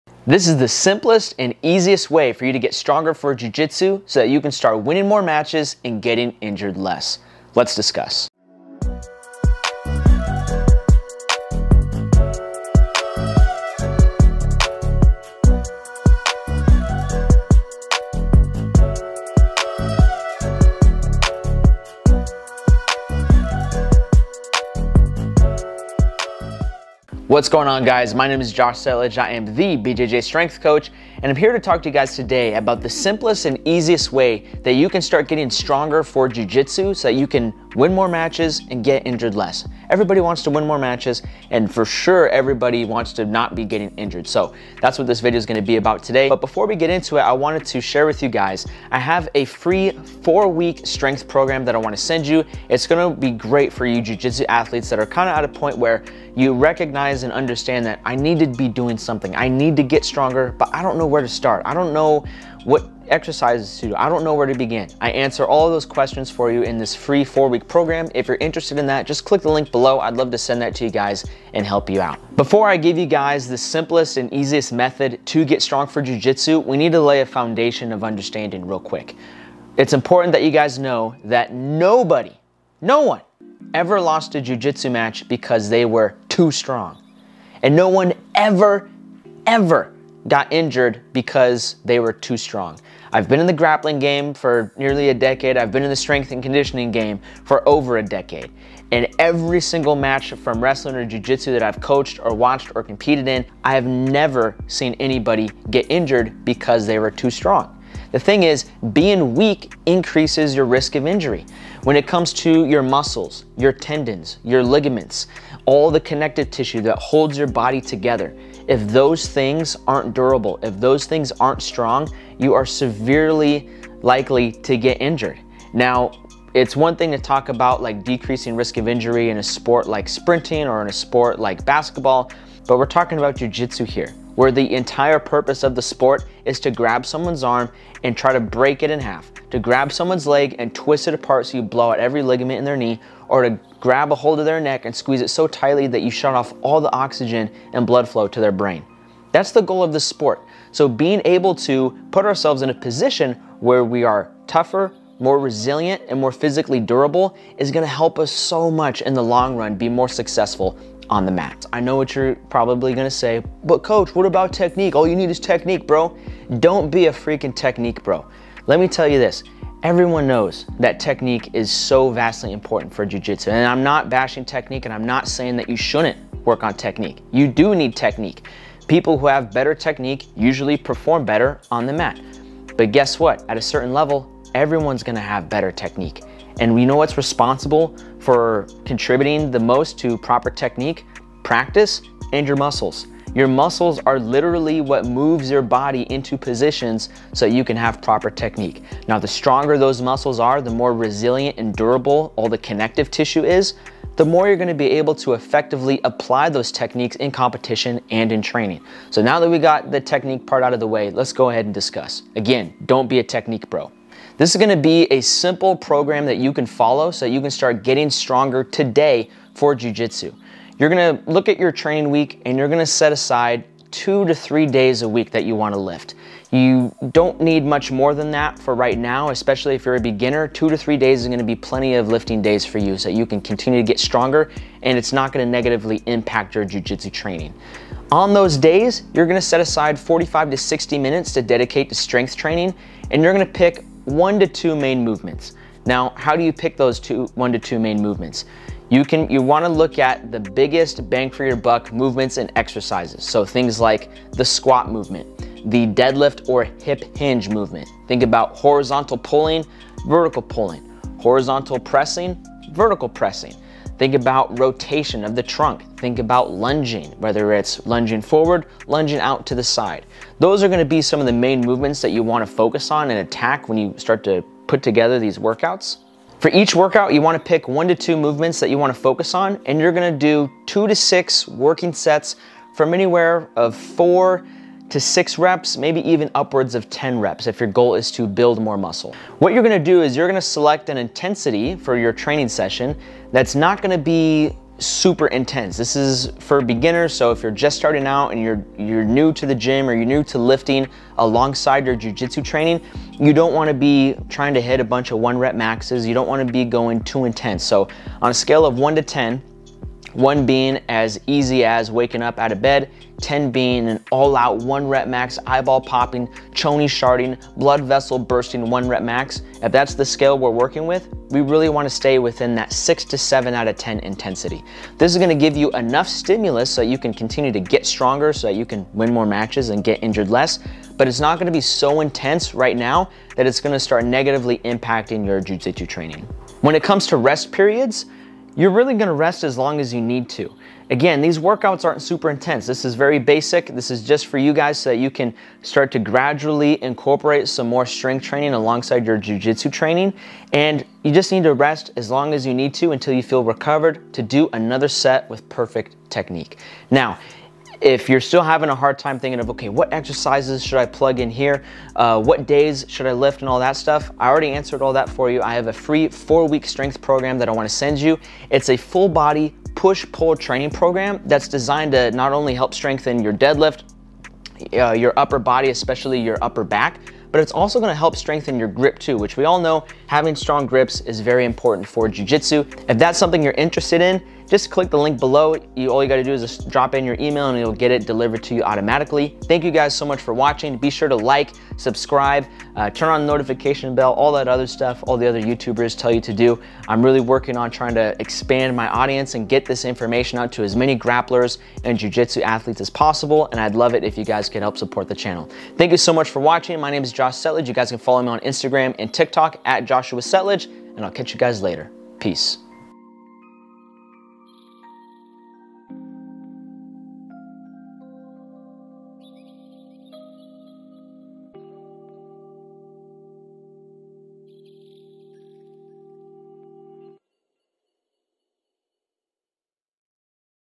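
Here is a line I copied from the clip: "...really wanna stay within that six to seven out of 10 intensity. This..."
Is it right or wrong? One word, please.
right.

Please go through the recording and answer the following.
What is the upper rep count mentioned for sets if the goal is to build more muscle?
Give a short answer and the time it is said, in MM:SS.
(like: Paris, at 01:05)
10, at 04:46.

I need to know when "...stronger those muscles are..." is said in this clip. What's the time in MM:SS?
03:19.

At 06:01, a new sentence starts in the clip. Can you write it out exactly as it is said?
Uh, what days should I lift and all that stuff?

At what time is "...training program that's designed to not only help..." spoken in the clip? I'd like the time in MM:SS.
06:10.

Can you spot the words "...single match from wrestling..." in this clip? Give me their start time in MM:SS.
01:39.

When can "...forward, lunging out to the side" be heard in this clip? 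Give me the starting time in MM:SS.
04:28.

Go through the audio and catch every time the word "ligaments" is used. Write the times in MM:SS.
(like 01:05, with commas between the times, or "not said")
01:54, 02:22.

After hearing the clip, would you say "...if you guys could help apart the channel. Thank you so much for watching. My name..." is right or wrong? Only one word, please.
wrong.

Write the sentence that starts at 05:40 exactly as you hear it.
Again, these workouts aren't super intense.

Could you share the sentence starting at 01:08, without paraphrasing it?
If you're interested in that, just click the link below.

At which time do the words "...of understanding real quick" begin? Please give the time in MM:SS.
01:17.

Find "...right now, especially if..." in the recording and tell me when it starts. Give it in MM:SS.
03:48.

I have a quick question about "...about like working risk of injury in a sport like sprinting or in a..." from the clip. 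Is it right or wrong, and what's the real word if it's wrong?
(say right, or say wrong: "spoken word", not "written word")
wrong: "decreasing", not "working".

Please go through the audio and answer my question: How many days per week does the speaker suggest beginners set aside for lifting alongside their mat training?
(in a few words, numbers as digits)
2 to 3.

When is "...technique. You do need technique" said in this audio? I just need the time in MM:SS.
02:56.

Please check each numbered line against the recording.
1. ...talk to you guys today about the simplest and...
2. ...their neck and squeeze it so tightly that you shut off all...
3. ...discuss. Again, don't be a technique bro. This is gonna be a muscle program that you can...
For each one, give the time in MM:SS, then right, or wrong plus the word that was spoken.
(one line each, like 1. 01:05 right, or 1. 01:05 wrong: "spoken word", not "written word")
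1. 00:31 right
2. 02:24 right
3. 03:31 wrong: "simple", not "muscle".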